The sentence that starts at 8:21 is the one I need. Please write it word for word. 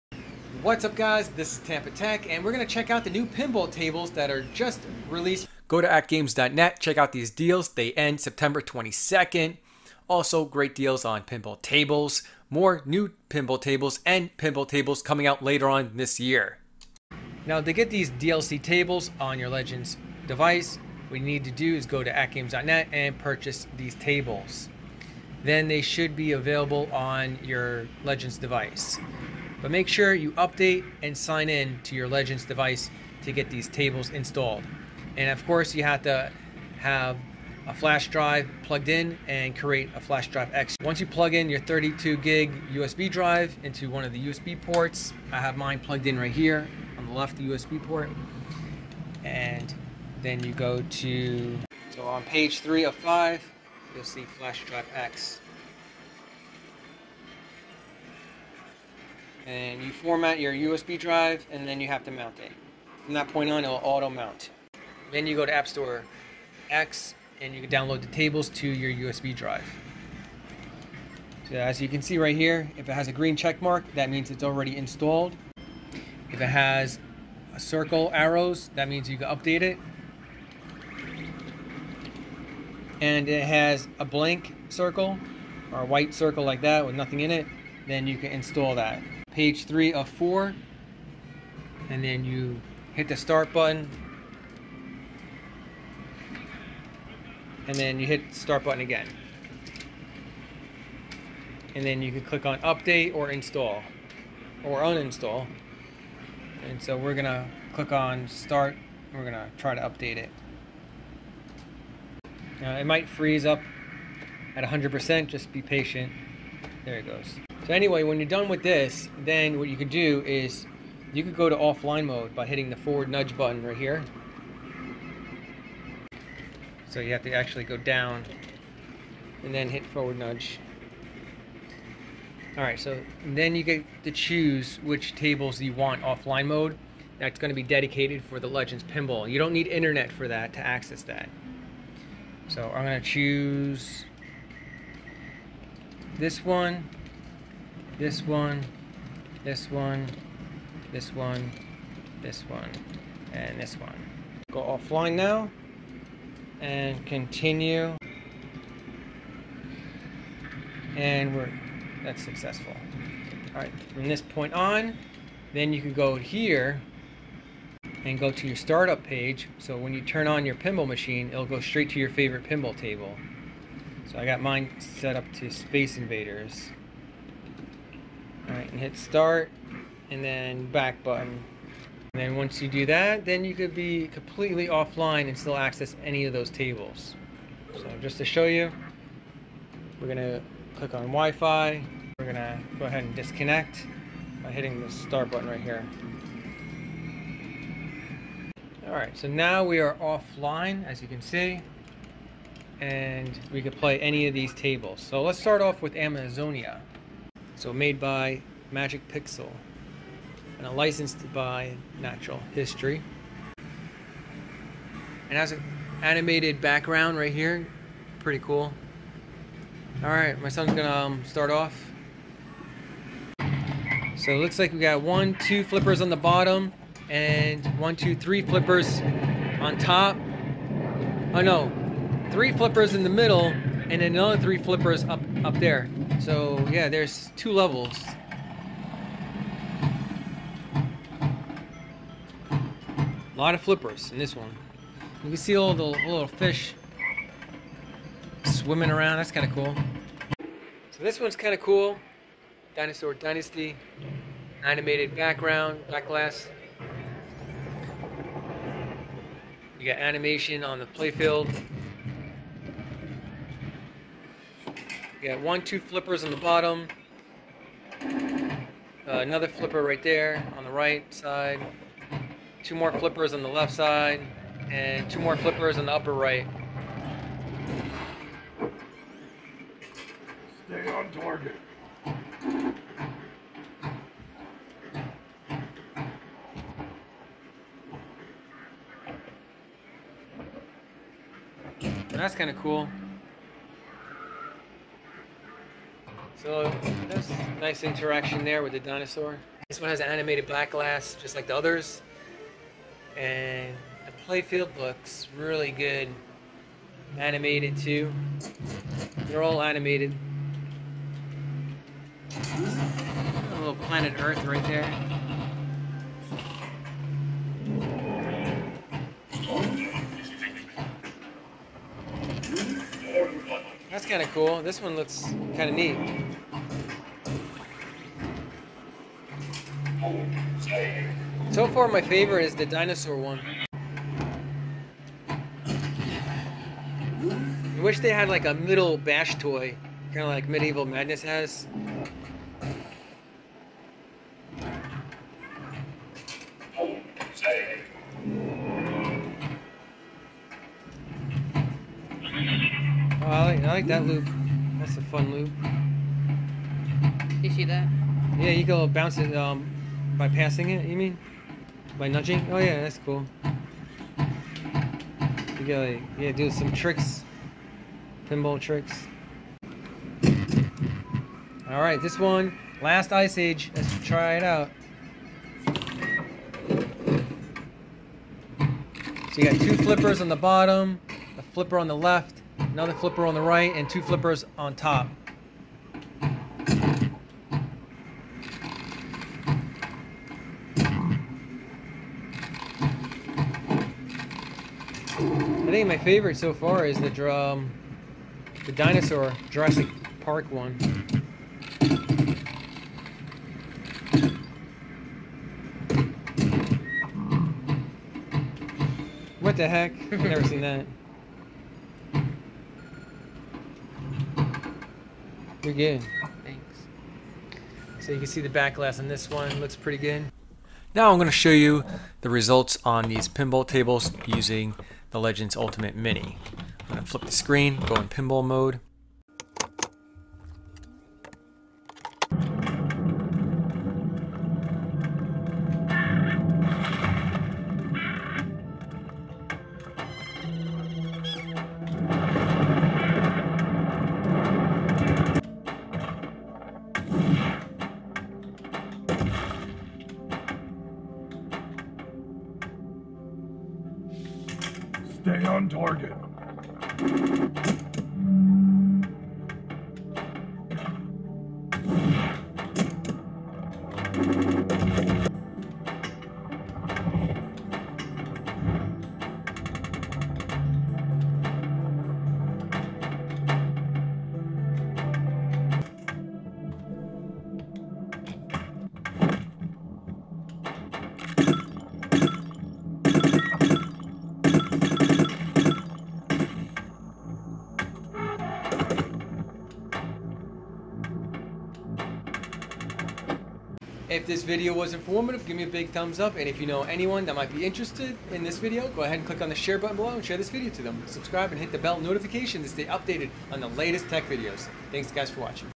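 Subscribe and hit the bell notification to stay updated on the latest tech videos.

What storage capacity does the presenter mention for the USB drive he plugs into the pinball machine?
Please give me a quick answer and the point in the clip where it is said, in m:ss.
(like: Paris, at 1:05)
32 gig, at 0:41.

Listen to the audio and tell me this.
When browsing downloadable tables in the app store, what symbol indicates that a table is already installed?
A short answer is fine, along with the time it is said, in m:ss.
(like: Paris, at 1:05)
green check mark, at 1:13.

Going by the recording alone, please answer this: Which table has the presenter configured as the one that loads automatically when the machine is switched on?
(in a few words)
Space Invaders.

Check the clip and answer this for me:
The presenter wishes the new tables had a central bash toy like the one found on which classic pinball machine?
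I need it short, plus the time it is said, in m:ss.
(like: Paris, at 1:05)
Medieval Madness, at 5:40.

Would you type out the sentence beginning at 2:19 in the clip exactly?
You don't need internet for that to access that.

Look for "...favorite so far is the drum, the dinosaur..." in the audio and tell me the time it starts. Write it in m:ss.
6:35.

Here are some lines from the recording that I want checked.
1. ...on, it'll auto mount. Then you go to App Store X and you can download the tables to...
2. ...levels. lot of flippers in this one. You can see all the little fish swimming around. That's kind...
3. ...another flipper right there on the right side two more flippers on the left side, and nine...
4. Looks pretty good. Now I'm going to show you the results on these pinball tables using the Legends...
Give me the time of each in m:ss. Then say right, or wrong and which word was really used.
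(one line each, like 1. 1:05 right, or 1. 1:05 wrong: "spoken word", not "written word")
1. 1:03 right
2. 3:57 right
3. 4:29 wrong: "two", not "nine"
4. 6:59 right.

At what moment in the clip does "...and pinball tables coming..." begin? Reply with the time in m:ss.
0:14.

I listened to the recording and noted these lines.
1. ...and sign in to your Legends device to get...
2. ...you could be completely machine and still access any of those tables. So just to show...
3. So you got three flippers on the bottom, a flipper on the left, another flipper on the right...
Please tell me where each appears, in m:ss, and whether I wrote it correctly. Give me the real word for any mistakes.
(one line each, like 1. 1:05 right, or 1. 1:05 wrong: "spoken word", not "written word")
1. 0:31 right
2. 3:03 wrong: "offline", not "machine"
3. 6:18 wrong: "two", not "three".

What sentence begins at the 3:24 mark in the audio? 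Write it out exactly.
So let's start off with Amazonia.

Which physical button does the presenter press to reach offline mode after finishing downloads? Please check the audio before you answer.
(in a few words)
forward nudge button.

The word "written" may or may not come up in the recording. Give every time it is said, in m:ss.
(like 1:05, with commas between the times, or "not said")
not said.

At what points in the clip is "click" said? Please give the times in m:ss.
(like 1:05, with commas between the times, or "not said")
1:42, 1:47, 3:10, 8:19.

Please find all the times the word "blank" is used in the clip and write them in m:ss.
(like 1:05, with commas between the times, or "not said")
1:24.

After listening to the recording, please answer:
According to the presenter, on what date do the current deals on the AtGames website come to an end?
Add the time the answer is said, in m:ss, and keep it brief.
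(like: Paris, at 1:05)
September 22nd, at 0:08.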